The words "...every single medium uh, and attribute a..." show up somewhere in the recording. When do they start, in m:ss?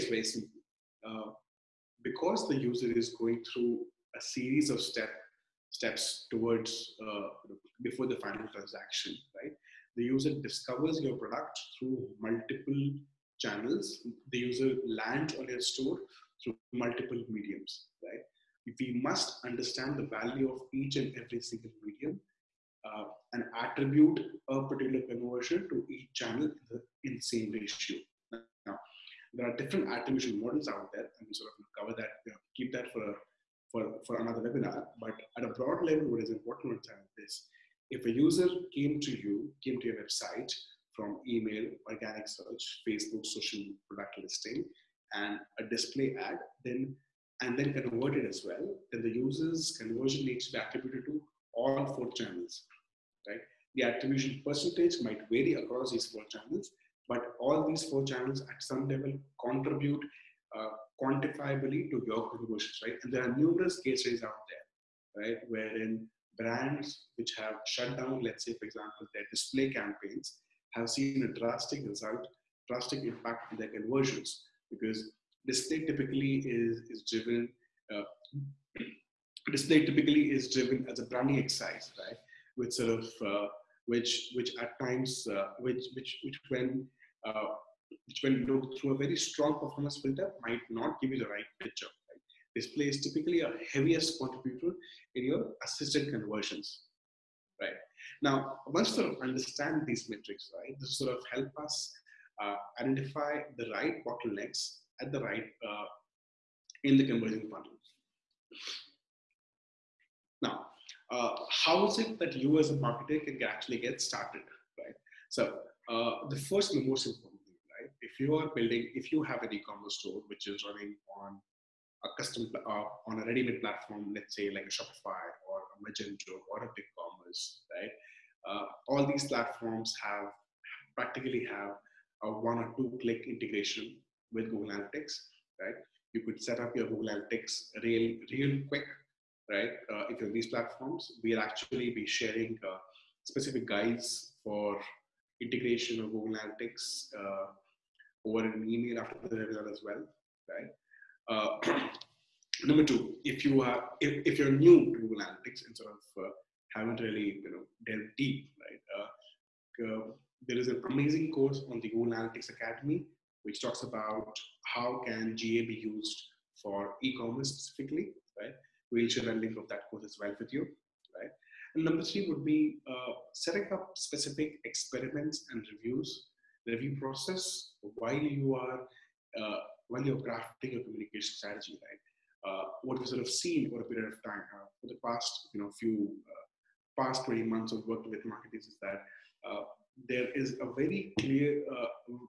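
0:21.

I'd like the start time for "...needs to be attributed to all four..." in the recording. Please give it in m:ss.
0:50.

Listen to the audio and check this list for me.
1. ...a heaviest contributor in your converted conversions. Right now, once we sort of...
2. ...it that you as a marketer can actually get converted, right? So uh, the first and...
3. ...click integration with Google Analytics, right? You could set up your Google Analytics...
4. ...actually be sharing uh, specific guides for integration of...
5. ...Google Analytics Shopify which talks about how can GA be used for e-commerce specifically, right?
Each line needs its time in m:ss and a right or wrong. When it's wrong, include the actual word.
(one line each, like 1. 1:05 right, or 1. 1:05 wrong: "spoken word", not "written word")
1. 1:33 wrong: "assisted", not "converted"
2. 1:51 wrong: "started", not "converted"
3. 2:13 right
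4. 2:21 right
5. 2:41 wrong: "Academy", not "Shopify".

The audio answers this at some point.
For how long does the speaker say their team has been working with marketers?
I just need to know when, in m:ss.
3:07.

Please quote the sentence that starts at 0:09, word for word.
The user discovers your product through multiple channels.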